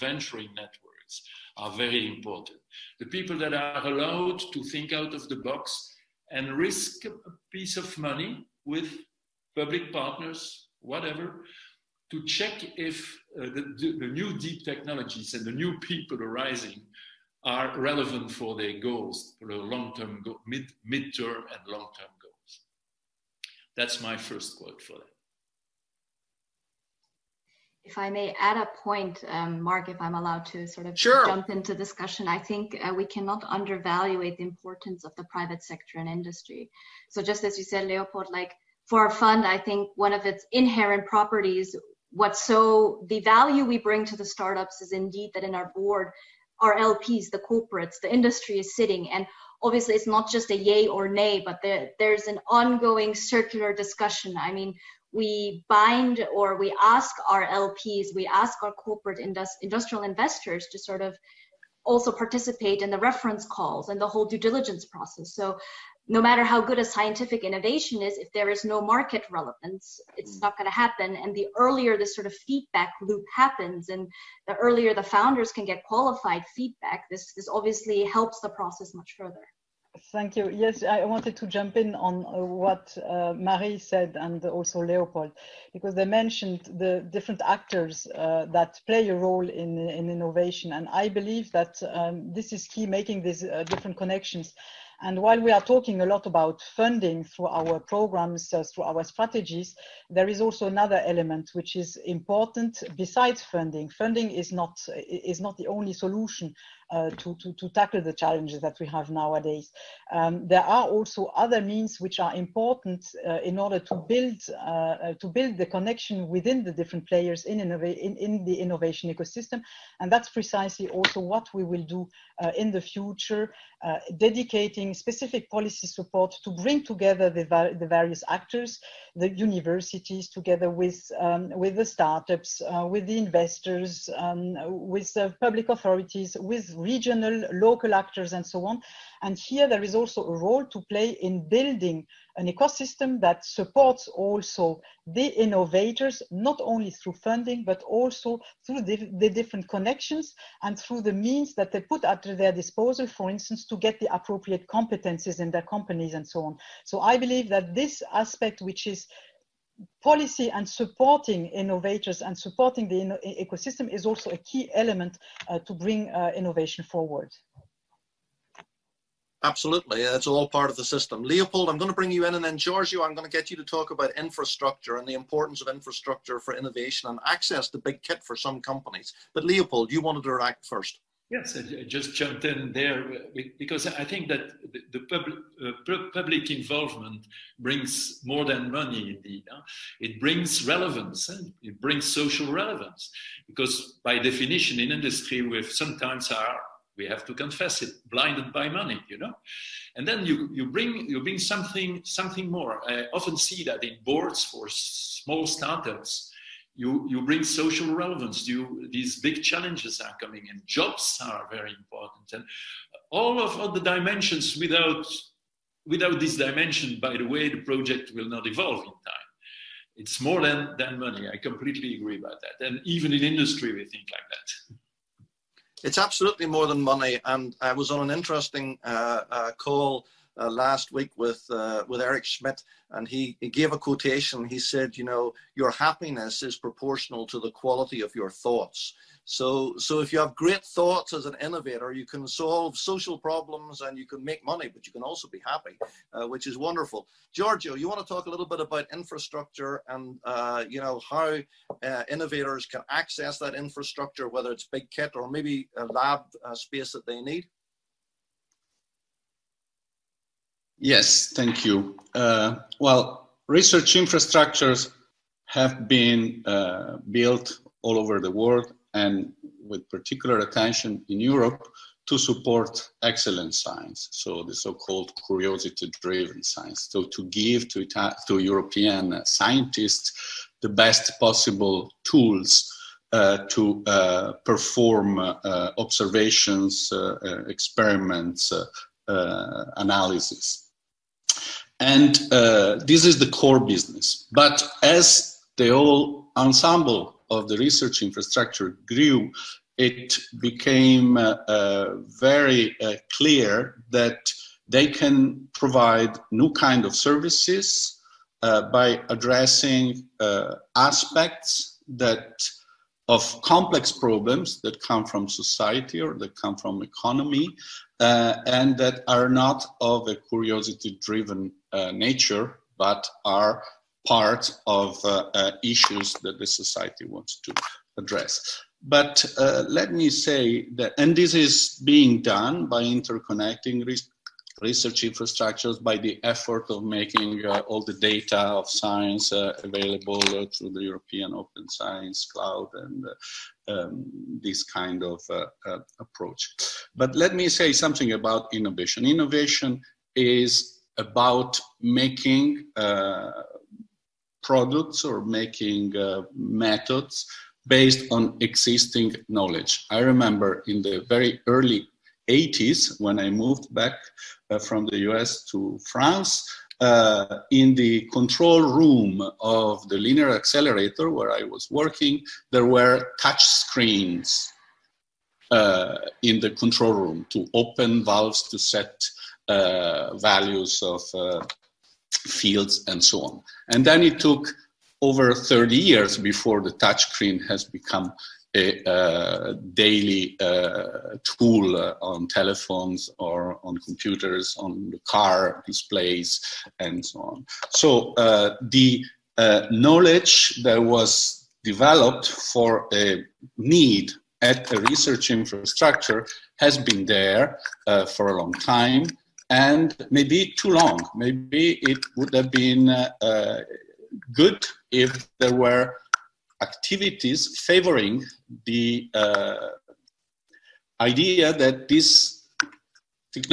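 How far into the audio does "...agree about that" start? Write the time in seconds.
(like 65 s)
221 s.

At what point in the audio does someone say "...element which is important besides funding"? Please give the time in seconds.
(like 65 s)
101 s.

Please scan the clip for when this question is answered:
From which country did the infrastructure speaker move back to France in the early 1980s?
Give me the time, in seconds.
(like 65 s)
364 s.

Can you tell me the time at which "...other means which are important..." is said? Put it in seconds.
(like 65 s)
111 s.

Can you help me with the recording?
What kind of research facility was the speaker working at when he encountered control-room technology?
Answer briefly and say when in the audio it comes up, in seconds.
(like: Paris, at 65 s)
linear accelerator, at 369 s.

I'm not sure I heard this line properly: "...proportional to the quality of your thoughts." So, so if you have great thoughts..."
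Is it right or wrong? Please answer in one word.
right.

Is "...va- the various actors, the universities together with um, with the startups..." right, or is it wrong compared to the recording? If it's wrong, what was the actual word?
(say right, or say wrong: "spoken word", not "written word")
right.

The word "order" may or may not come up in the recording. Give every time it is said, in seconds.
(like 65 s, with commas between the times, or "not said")
113 s.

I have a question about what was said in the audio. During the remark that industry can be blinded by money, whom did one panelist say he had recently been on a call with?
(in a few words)
Eric Schmidt.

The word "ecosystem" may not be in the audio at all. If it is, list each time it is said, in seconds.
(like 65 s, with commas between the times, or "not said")
119 s, 142 s, 163 s.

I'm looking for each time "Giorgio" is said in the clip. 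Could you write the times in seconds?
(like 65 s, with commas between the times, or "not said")
172 s, 247 s.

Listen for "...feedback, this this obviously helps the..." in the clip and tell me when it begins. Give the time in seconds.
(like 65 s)
76 s.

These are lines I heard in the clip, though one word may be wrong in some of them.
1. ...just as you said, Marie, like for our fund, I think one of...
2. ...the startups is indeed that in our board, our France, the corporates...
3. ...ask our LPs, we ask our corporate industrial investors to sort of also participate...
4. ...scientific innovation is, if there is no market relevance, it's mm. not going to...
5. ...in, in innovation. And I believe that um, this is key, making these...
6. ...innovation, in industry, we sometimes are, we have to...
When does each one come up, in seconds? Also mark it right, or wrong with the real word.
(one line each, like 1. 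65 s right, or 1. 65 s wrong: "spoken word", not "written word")
1. 37 s wrong: "Leopold", not "Marie"
2. 44 s wrong: "LPs", not "France"
3. 56 s right
4. 66 s right
5. 89 s right
6. 194 s wrong: "definition", not "innovation".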